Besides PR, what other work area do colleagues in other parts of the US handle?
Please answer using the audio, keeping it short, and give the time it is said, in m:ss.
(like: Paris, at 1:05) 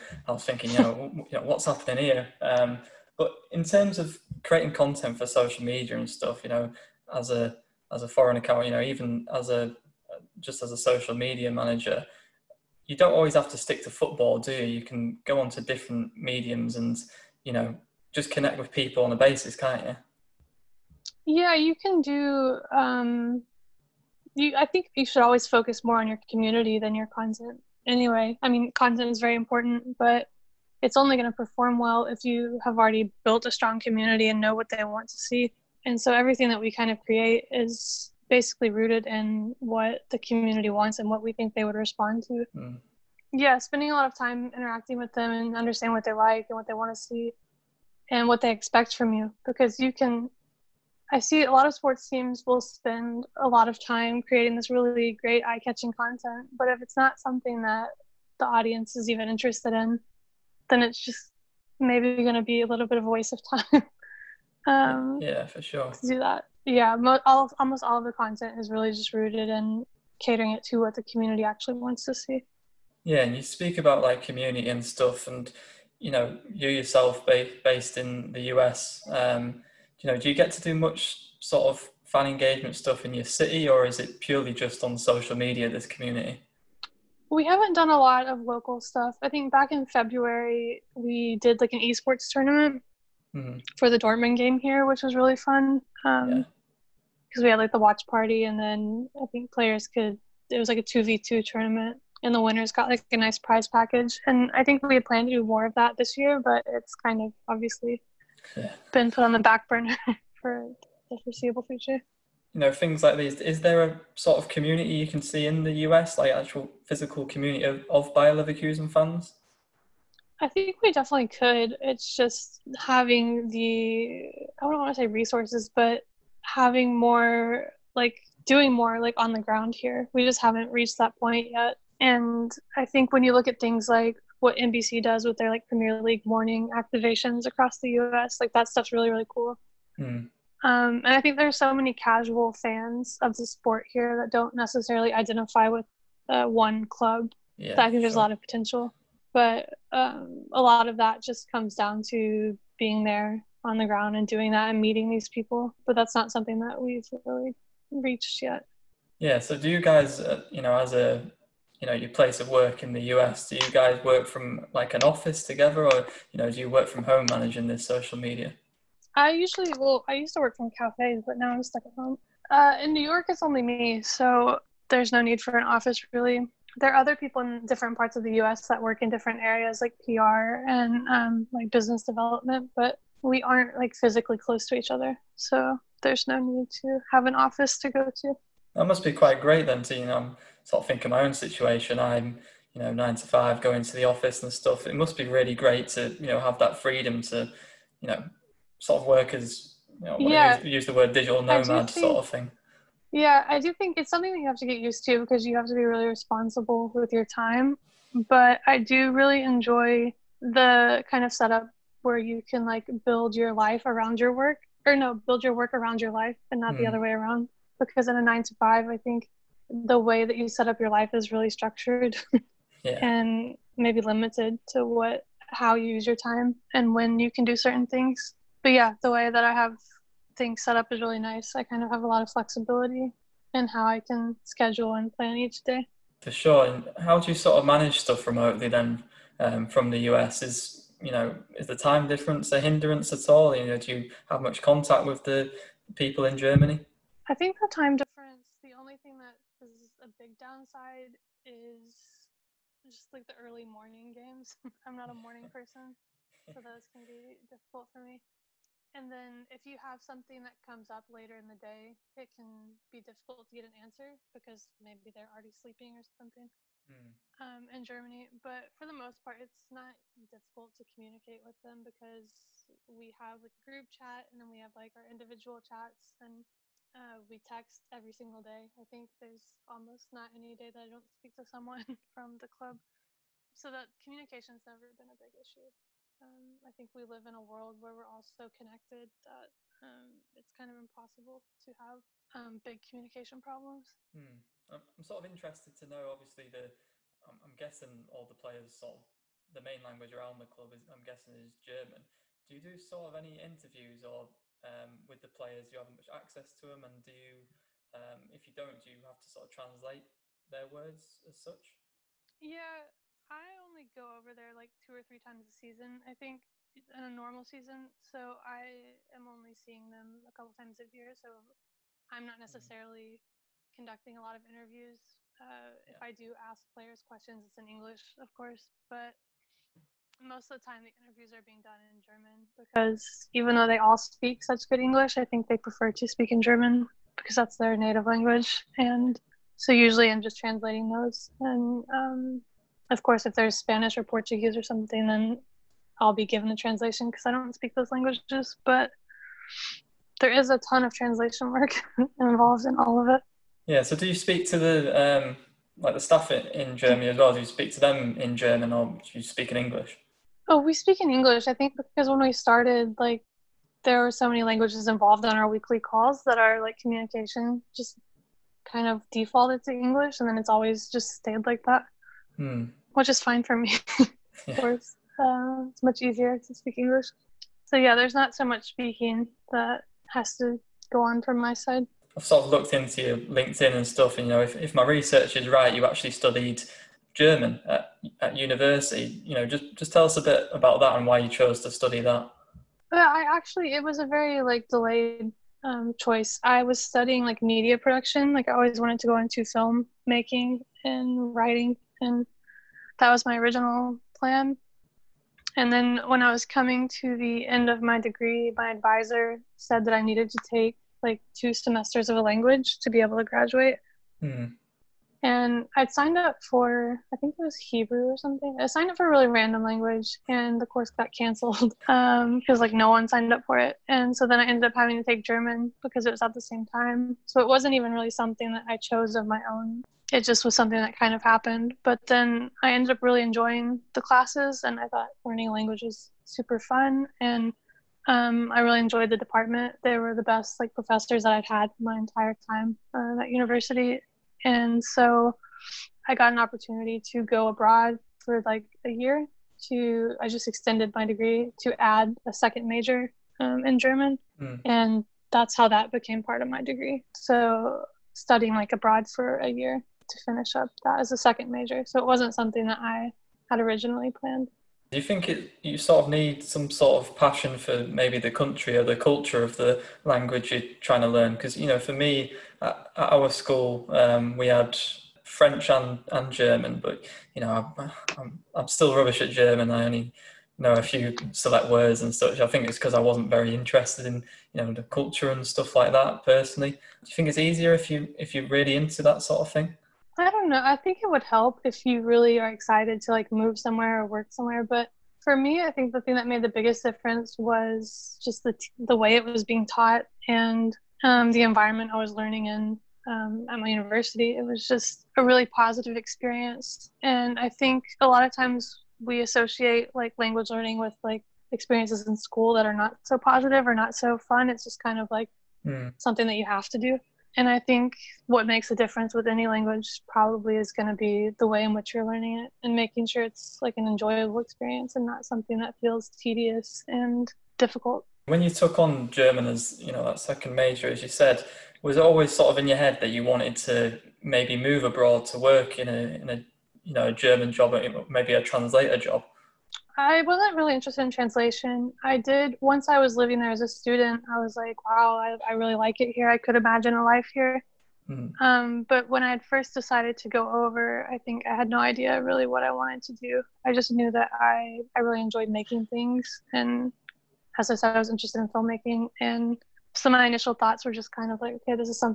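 business development, at 3:01.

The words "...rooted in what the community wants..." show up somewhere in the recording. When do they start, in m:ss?
0:38.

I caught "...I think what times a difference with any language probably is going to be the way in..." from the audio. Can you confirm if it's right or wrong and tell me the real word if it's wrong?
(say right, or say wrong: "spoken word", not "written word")
wrong: "makes", not "times".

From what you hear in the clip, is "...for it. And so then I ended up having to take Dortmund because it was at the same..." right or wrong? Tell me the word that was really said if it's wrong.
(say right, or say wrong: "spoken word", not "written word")
wrong: "German", not "Dortmund".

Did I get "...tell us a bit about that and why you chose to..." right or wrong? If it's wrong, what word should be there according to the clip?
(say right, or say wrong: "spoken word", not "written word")
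right.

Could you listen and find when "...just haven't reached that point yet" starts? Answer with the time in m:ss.
2:10.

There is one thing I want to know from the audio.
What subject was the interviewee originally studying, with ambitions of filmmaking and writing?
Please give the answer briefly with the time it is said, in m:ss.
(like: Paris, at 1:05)
media production, at 6:37.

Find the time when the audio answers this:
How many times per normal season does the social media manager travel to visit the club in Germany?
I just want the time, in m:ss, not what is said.
5:14.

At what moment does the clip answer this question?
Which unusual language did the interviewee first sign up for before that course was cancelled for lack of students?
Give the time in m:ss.
6:57.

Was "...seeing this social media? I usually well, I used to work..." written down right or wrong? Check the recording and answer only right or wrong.
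wrong.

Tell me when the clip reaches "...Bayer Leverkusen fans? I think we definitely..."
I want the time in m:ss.
1:58.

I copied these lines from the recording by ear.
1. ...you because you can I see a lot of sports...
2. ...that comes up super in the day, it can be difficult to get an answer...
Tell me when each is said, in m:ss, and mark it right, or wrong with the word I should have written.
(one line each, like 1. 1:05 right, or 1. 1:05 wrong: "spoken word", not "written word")
1. 0:49 right
2. 4:20 wrong: "later", not "super".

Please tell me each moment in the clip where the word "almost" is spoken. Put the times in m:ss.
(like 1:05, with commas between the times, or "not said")
1:07, 4:39.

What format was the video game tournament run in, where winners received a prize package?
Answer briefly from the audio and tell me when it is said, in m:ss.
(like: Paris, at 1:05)
2v2, at 1:40.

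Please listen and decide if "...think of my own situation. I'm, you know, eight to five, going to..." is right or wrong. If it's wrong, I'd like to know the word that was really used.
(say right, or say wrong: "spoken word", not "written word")
wrong: "nine", not "eight".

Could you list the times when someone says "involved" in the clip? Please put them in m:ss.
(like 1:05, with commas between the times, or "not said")
5:52, 6:04.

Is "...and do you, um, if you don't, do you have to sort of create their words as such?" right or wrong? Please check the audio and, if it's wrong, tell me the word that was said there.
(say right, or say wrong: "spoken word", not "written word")
wrong: "translate", not "create".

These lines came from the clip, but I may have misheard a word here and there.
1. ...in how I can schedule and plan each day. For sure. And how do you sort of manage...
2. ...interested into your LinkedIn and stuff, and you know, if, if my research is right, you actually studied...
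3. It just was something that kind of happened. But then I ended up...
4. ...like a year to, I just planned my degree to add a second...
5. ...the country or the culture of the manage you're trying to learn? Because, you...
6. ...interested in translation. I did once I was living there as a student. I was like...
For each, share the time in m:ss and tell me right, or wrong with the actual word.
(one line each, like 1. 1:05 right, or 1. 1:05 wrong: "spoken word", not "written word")
1. 3:53 right
2. 6:22 wrong: "looked", not "interested"
3. 7:10 right
4. 7:28 wrong: "extended", not "planned"
5. 7:48 wrong: "language", not "manage"
6. 9:00 right.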